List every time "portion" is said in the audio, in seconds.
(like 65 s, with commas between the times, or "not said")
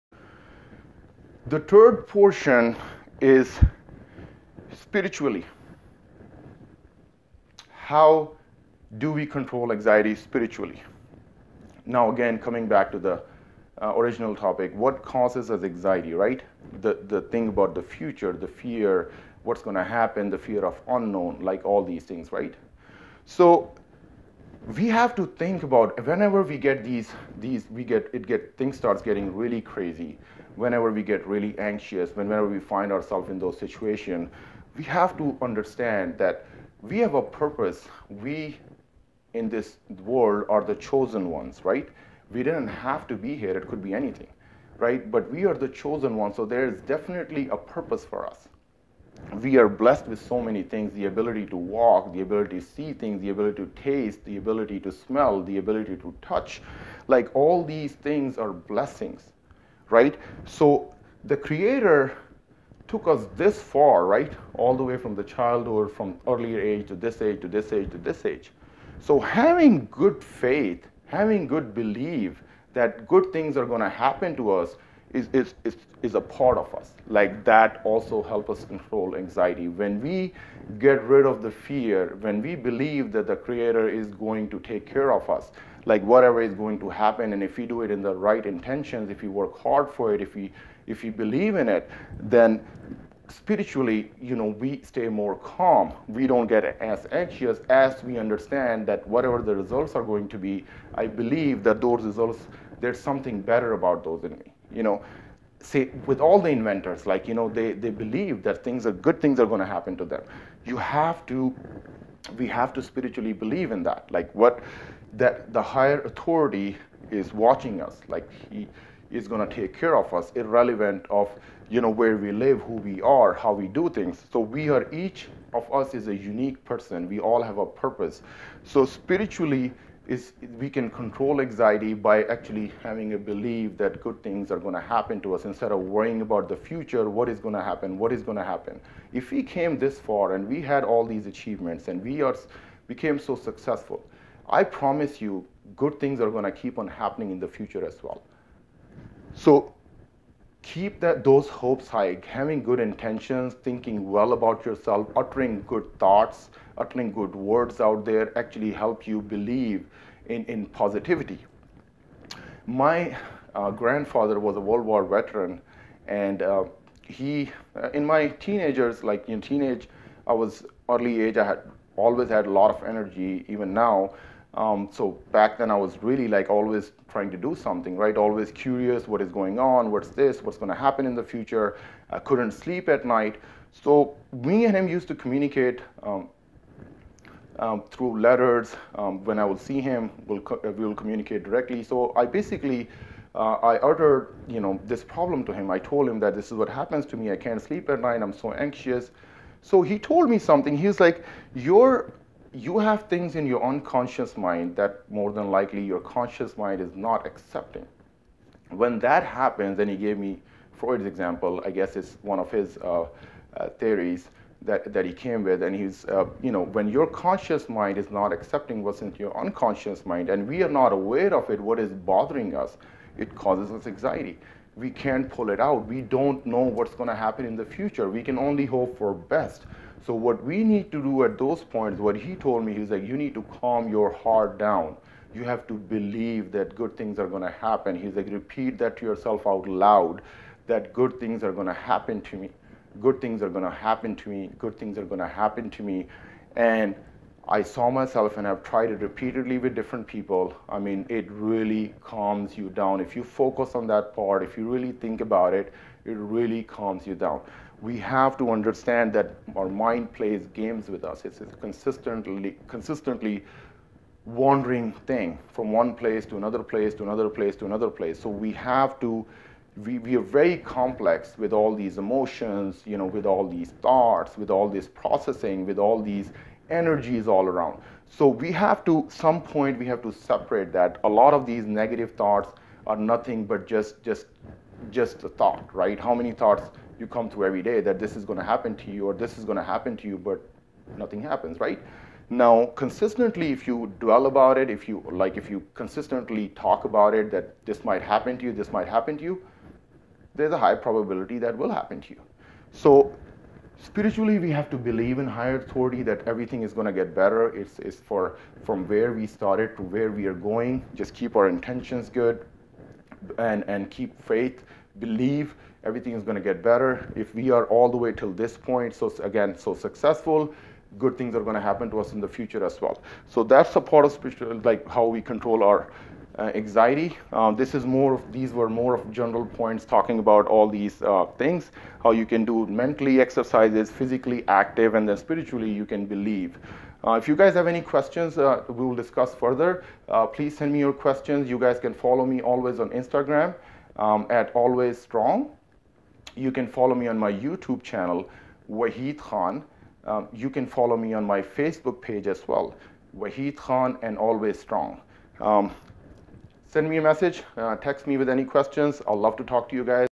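2 s.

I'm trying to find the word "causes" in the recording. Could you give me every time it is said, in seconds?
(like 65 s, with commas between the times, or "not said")
15 s, 223 s.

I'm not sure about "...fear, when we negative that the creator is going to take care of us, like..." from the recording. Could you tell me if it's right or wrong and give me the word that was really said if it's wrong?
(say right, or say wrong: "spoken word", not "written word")
wrong: "believe", not "negative".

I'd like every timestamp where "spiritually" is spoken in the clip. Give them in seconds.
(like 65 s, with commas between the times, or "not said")
4 s, 10 s, 93 s, 112 s, 128 s, 303 s, 335 s.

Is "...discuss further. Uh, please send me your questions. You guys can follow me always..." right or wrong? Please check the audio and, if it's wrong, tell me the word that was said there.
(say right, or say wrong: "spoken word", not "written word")
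right.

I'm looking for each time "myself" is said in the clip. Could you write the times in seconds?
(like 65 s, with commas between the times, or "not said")
247 s.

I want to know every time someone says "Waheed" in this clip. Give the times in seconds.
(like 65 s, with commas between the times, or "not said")
348 s, 353 s.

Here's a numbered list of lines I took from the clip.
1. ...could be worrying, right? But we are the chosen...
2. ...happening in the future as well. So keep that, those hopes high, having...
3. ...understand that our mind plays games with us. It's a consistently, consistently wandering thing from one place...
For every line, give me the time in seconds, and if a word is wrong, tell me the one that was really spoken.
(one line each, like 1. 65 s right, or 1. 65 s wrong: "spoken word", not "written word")
1. 43 s wrong: "anything", not "worrying"
2. 146 s right
3. 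258 s right.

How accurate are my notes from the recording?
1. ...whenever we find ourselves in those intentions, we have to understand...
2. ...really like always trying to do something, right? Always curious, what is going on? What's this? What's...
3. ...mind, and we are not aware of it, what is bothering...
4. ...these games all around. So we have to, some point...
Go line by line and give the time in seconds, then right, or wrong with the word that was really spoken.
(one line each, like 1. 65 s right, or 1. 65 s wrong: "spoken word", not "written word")
1. 32 s wrong: "situations", not "intentions"
2. 176 s right
3. 220 s right
4. 276 s wrong: "energies", not "games".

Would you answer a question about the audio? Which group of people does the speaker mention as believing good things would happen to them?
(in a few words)
Inventors.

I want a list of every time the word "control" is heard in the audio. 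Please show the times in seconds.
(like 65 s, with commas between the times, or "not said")
9 s, 78 s, 130 s, 325 s.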